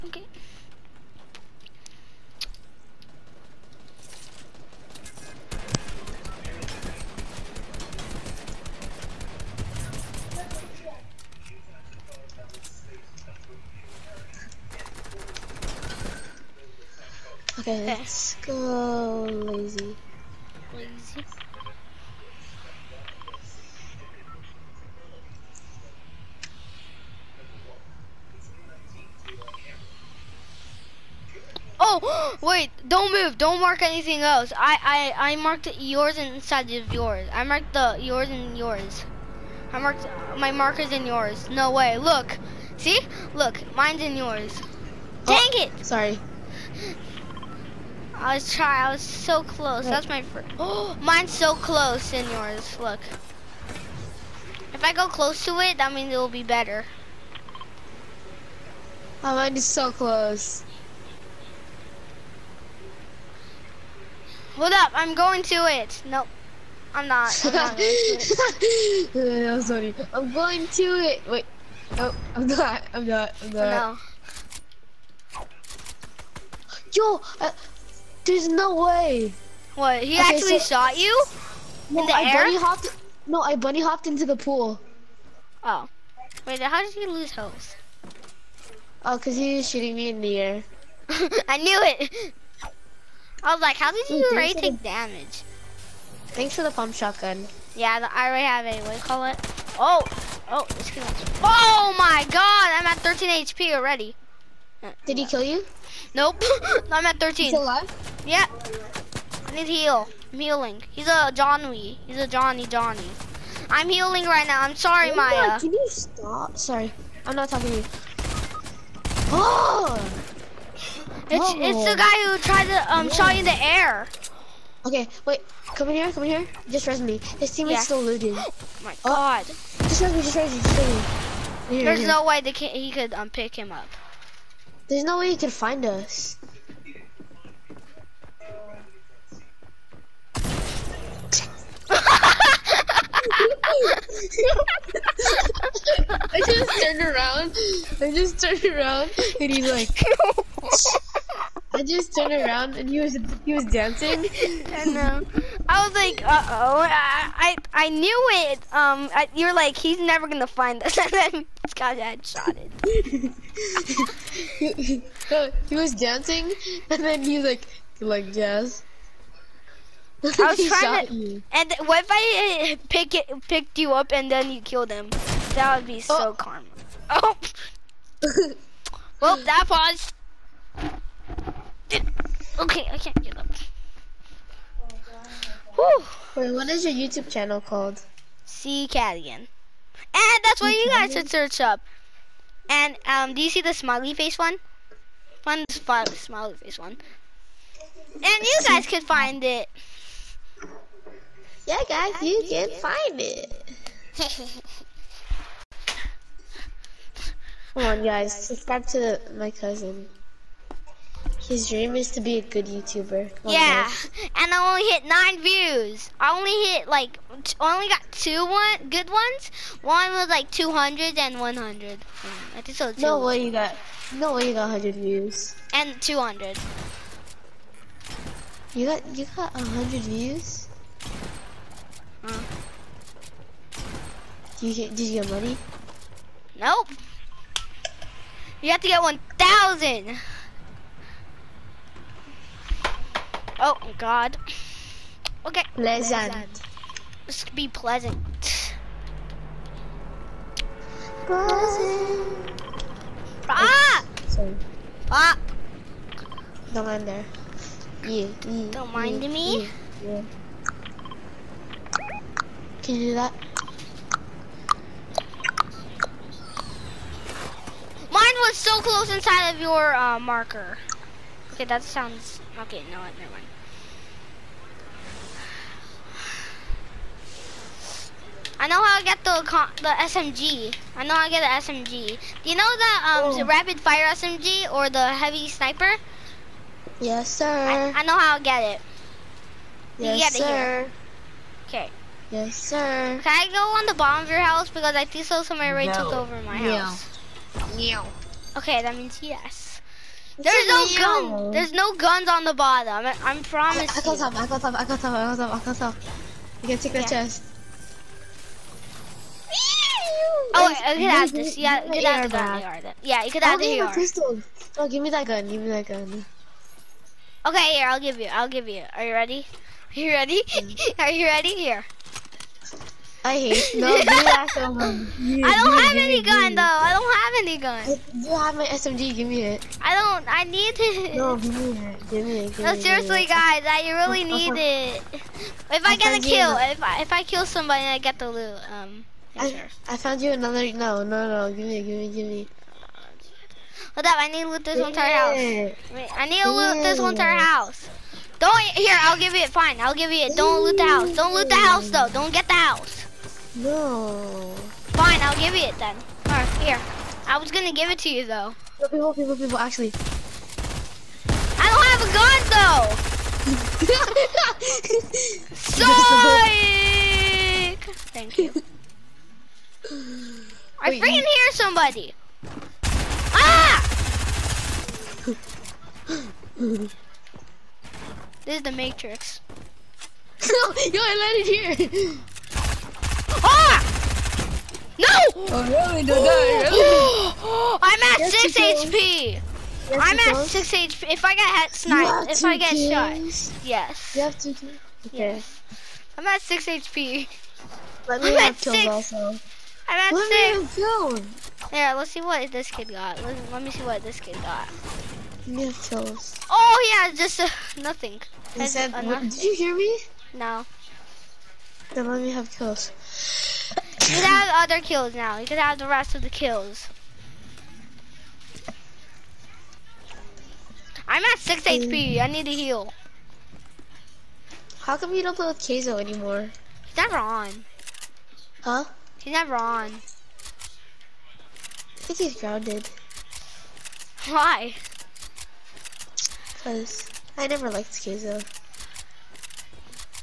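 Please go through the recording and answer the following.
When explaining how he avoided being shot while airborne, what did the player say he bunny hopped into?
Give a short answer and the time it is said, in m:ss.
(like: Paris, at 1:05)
the pool, at 1:24.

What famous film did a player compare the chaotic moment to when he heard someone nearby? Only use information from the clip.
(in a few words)
The Matrix.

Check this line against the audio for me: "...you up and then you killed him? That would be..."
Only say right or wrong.
right.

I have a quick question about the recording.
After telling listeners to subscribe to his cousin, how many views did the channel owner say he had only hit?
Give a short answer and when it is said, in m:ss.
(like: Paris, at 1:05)
9, at 3:35.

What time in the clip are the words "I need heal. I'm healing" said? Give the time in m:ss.
1:49.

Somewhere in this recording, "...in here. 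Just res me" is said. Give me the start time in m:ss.
2:06.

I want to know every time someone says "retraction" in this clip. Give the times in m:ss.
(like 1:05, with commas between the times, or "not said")
not said.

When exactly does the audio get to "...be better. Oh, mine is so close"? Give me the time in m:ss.
0:56.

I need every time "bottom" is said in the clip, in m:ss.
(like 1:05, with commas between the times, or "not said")
4:53, 5:02.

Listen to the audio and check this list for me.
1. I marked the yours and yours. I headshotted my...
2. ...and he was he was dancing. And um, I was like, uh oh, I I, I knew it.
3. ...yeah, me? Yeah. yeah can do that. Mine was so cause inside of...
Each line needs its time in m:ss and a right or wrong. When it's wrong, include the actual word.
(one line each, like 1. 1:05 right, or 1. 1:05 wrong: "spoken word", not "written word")
1. 0:37 wrong: "marked", not "headshotted"
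2. 2:32 right
3. 4:19 wrong: "close", not "cause".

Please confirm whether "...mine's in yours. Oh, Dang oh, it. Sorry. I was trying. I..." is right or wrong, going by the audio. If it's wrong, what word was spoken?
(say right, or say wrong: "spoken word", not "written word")
right.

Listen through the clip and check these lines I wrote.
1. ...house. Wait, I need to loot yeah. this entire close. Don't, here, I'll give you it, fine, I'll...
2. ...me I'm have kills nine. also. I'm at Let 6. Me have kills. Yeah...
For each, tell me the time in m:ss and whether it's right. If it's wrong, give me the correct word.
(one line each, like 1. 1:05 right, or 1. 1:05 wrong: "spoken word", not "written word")
1. 5:45 wrong: "house", not "close"
2. 6:38 wrong: "six", not "nine".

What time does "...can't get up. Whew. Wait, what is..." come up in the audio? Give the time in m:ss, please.
3:02.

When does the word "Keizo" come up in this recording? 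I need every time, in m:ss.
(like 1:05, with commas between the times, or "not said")
7:05, 7:17.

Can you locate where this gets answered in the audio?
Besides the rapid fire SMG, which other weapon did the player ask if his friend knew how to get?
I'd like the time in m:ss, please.
4:45.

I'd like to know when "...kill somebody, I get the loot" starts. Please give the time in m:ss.
5:37.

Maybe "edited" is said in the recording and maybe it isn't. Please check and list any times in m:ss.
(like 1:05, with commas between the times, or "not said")
not said.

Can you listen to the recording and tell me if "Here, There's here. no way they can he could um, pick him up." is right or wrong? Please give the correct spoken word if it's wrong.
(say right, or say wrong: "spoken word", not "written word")
right.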